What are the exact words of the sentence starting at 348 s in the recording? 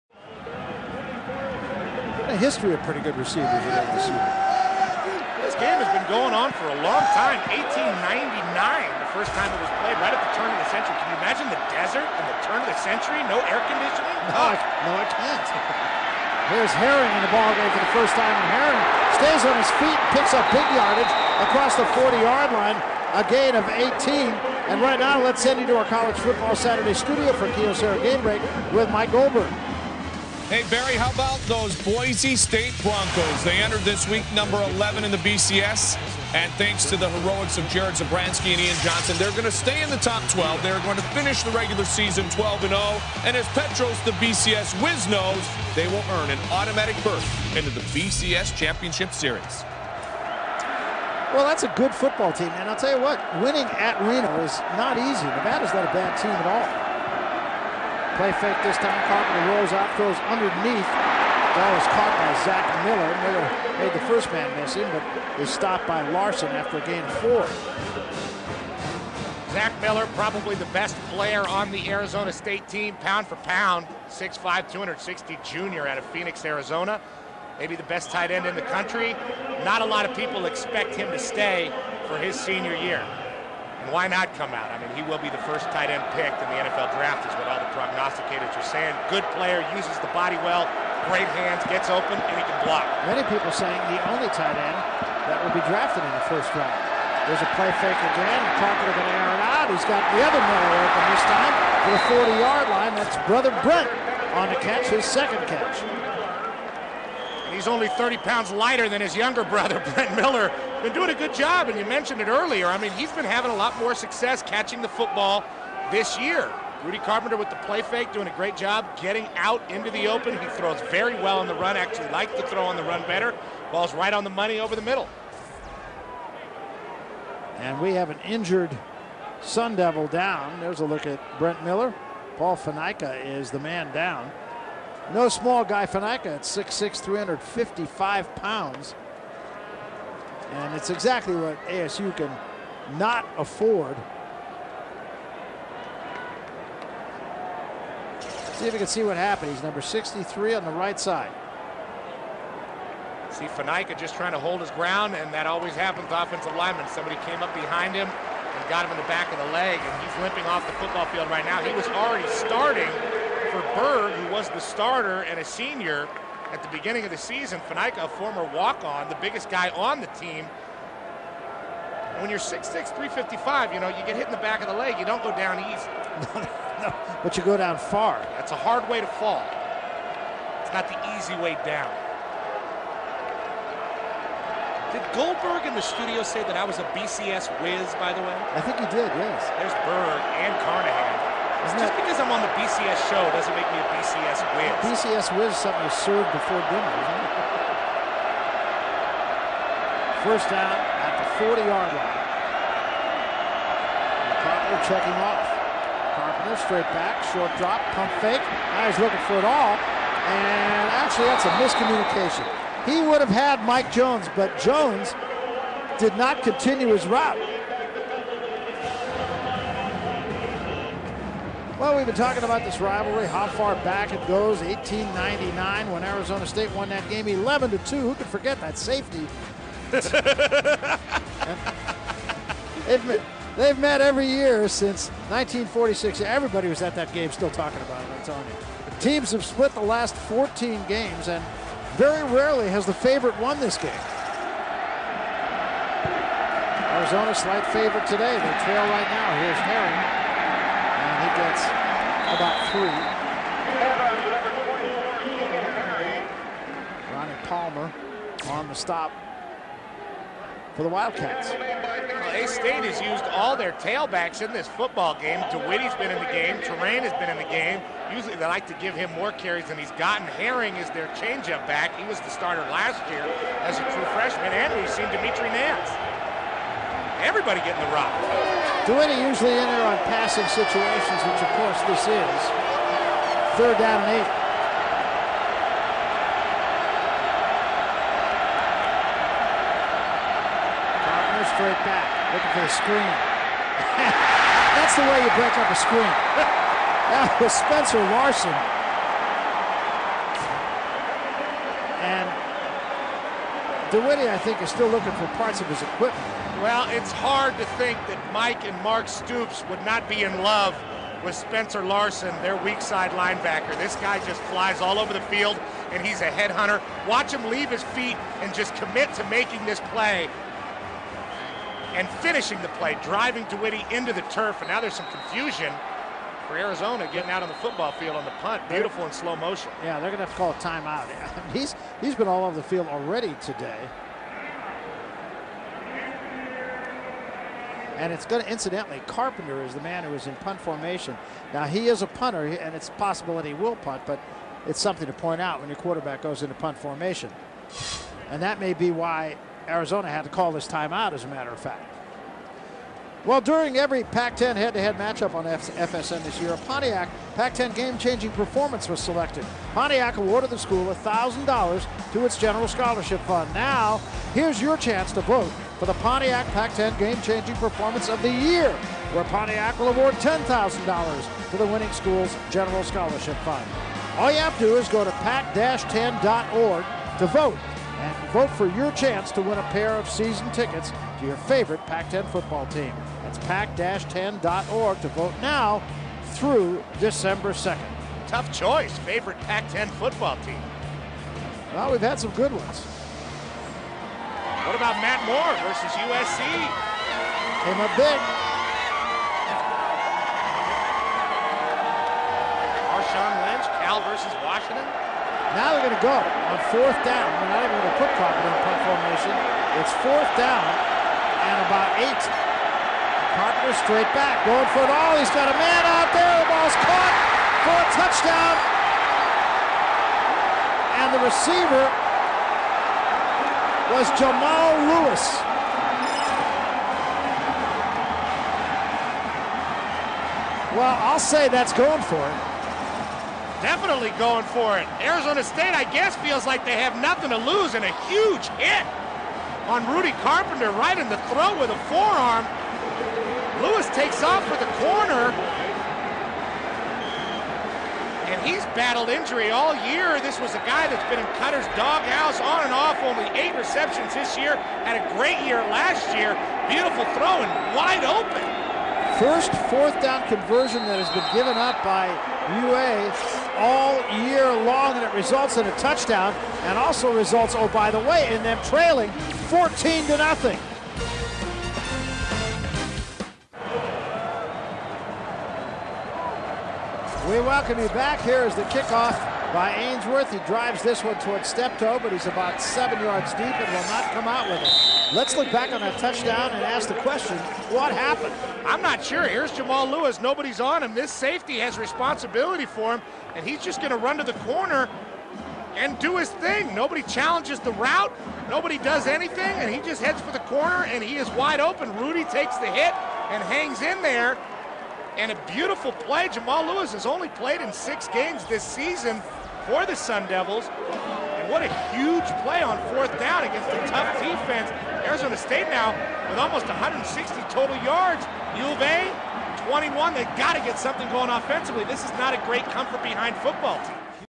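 And that may be why Arizona had to call this timeout, as a matter of fact.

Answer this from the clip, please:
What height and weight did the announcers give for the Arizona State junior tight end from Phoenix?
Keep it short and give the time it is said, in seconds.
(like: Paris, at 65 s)
6'5", 260, at 74 s.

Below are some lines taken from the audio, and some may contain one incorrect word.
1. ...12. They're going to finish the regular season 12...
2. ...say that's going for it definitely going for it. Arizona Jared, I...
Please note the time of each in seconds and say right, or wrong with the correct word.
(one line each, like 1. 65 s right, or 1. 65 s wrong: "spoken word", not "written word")
1. 40 s right
2. 431 s wrong: "State", not "Jared".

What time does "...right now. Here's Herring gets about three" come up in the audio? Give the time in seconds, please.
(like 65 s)
248 s.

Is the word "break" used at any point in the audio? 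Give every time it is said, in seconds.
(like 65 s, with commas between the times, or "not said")
28 s, 295 s.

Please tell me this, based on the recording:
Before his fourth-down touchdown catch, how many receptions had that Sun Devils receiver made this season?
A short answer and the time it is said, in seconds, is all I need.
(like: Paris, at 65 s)
8, at 453 s.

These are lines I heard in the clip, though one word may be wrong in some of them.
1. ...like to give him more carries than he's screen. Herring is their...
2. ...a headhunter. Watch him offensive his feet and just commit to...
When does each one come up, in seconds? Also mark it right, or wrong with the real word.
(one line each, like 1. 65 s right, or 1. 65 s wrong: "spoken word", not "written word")
1. 268 s wrong: "gotten", not "screen"
2. 316 s wrong: "leave", not "offensive".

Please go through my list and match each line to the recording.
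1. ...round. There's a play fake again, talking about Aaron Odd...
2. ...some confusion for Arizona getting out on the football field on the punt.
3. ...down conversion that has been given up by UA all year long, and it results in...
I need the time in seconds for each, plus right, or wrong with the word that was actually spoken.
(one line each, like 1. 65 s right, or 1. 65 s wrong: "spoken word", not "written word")
1. 96 s right
2. 324 s right
3. 460 s right.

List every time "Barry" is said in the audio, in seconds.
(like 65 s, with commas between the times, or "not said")
30 s.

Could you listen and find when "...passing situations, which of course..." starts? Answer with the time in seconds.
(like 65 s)
280 s.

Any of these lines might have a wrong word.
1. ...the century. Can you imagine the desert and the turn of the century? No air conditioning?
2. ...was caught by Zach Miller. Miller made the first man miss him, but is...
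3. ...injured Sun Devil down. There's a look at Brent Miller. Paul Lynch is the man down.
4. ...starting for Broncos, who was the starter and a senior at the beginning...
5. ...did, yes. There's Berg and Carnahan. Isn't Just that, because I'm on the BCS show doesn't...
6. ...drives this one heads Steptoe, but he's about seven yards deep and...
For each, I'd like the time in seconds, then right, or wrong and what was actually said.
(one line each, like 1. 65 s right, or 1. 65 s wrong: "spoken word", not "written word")
1. 10 s right
2. 61 s right
3. 128 s wrong: "Fanaika", not "Lynch"
4. 162 s wrong: "Berg", not "Broncos"
5. 188 s right
6. 480 s wrong: "towards", not "heads".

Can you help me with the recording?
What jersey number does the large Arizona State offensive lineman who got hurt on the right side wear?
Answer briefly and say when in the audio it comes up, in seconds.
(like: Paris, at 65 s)
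63, at 149 s.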